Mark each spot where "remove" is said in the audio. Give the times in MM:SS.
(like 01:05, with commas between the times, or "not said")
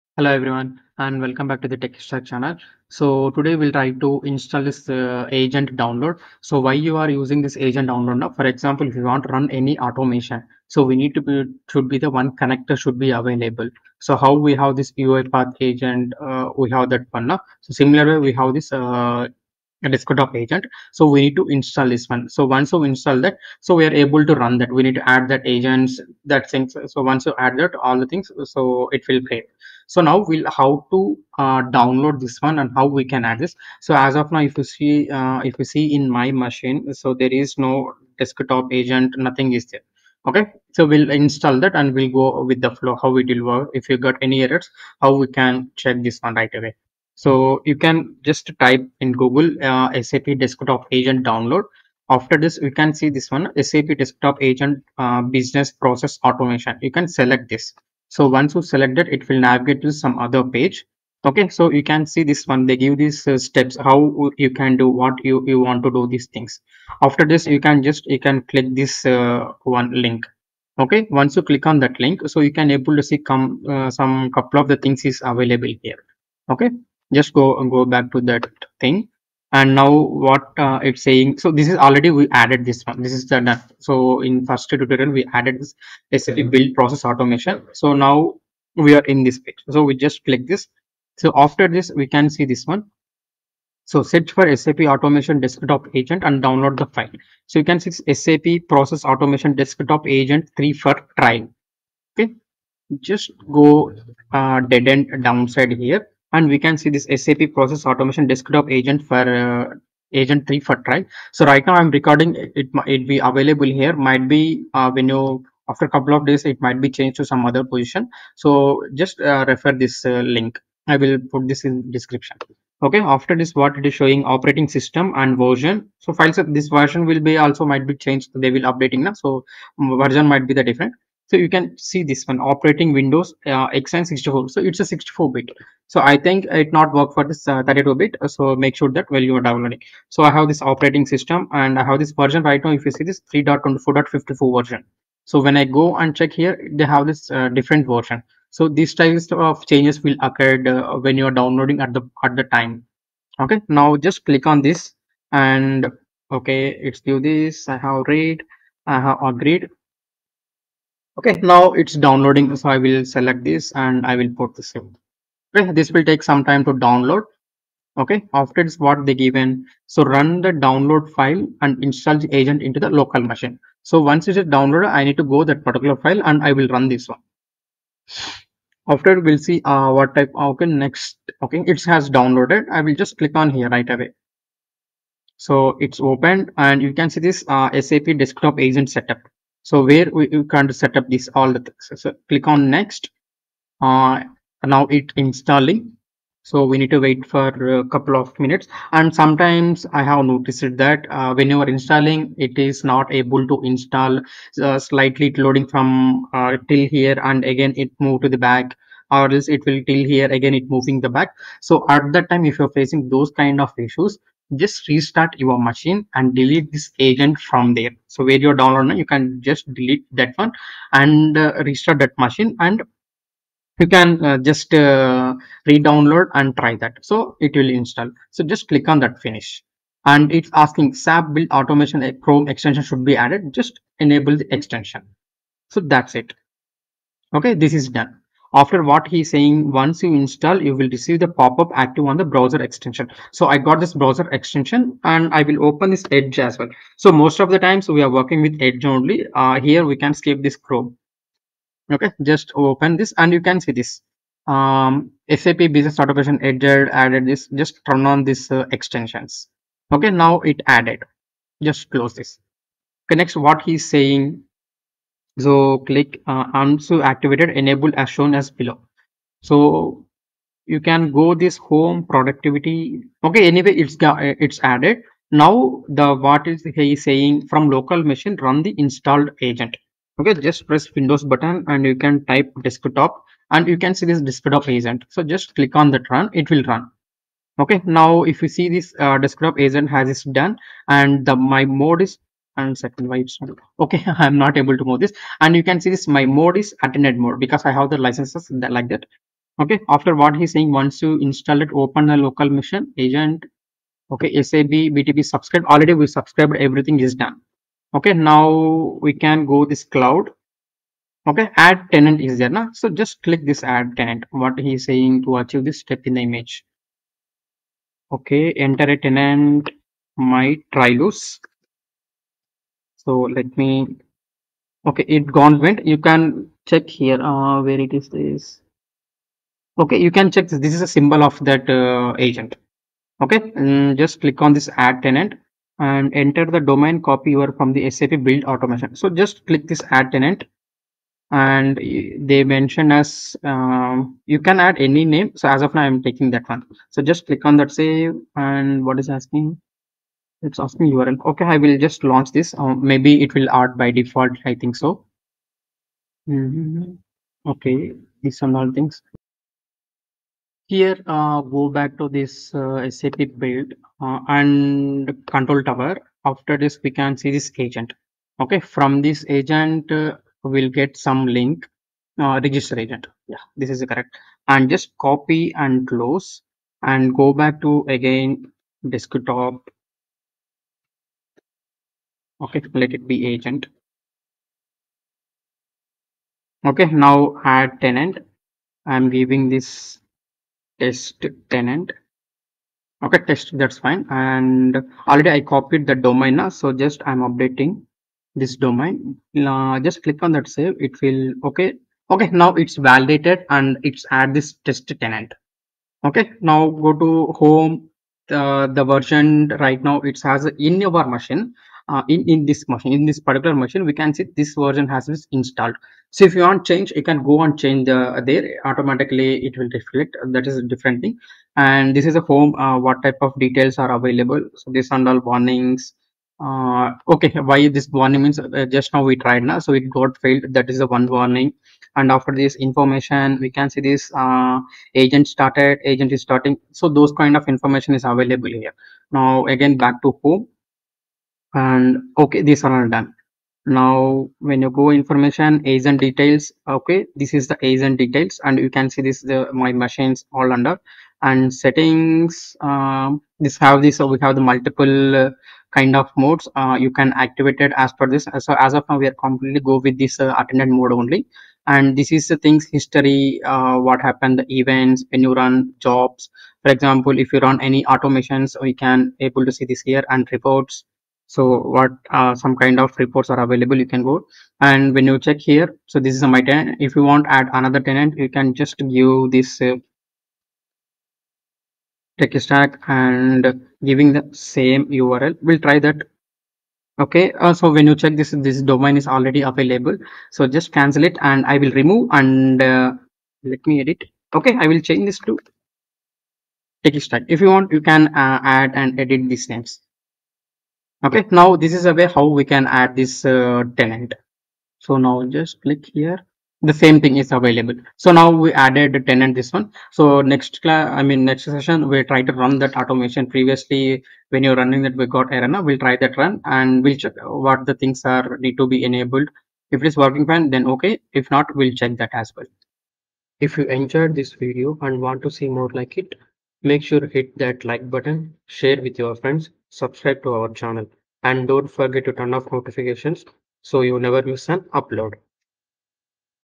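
08:11.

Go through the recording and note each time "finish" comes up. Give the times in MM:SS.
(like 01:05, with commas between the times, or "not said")
03:49.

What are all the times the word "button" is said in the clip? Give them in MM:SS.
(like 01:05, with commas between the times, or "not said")
04:41, 08:47.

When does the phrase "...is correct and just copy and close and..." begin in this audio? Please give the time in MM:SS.
06:13.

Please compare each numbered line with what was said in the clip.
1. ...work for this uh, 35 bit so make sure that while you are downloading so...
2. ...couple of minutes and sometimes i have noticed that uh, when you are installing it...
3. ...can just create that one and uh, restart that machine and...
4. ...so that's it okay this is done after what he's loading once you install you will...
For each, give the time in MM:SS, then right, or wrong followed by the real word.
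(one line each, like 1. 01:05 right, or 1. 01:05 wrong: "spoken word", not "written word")
1. 02:16 wrong: "32", not "35"
2. 03:17 right
3. 03:39 wrong: "delete", not "create"
4. 03:55 wrong: "saying", not "loading".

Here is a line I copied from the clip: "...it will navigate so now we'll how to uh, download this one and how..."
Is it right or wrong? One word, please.
wrong.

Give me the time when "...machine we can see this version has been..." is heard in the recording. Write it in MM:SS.
06:53.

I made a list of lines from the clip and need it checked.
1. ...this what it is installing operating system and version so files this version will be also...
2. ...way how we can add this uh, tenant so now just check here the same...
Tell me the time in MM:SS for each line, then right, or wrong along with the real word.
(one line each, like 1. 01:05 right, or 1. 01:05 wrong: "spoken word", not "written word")
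1. 02:03 wrong: "showing", not "installing"
2. 08:21 wrong: "click", not "check".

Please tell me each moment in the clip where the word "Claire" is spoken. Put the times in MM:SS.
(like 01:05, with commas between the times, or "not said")
not said.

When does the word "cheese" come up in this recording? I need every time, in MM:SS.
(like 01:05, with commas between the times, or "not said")
not said.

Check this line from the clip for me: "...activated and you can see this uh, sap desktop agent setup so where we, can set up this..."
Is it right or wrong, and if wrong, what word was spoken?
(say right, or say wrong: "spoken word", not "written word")
wrong: "opened", not "activated".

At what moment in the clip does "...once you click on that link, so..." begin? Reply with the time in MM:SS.
01:11.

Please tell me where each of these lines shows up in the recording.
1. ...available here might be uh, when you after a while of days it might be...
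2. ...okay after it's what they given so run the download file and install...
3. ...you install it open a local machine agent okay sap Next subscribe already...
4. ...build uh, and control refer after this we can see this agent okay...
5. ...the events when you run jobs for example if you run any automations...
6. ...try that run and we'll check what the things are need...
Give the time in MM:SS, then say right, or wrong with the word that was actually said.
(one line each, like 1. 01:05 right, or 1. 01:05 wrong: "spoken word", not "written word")
1. 01:53 wrong: "couple", not "while"
2. 02:47 right
3. 05:01 wrong: "BTP", not "Next"
4. 06:03 wrong: "tower", not "refer"
5. 07:44 right
6. 08:35 right.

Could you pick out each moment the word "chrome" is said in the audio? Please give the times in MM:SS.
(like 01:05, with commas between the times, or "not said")
03:52, 04:10.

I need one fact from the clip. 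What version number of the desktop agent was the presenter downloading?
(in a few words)
3.24.54.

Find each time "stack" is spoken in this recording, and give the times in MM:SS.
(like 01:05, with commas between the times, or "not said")
00:01, 08:02, 08:17.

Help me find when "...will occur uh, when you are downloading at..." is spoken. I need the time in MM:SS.
02:30.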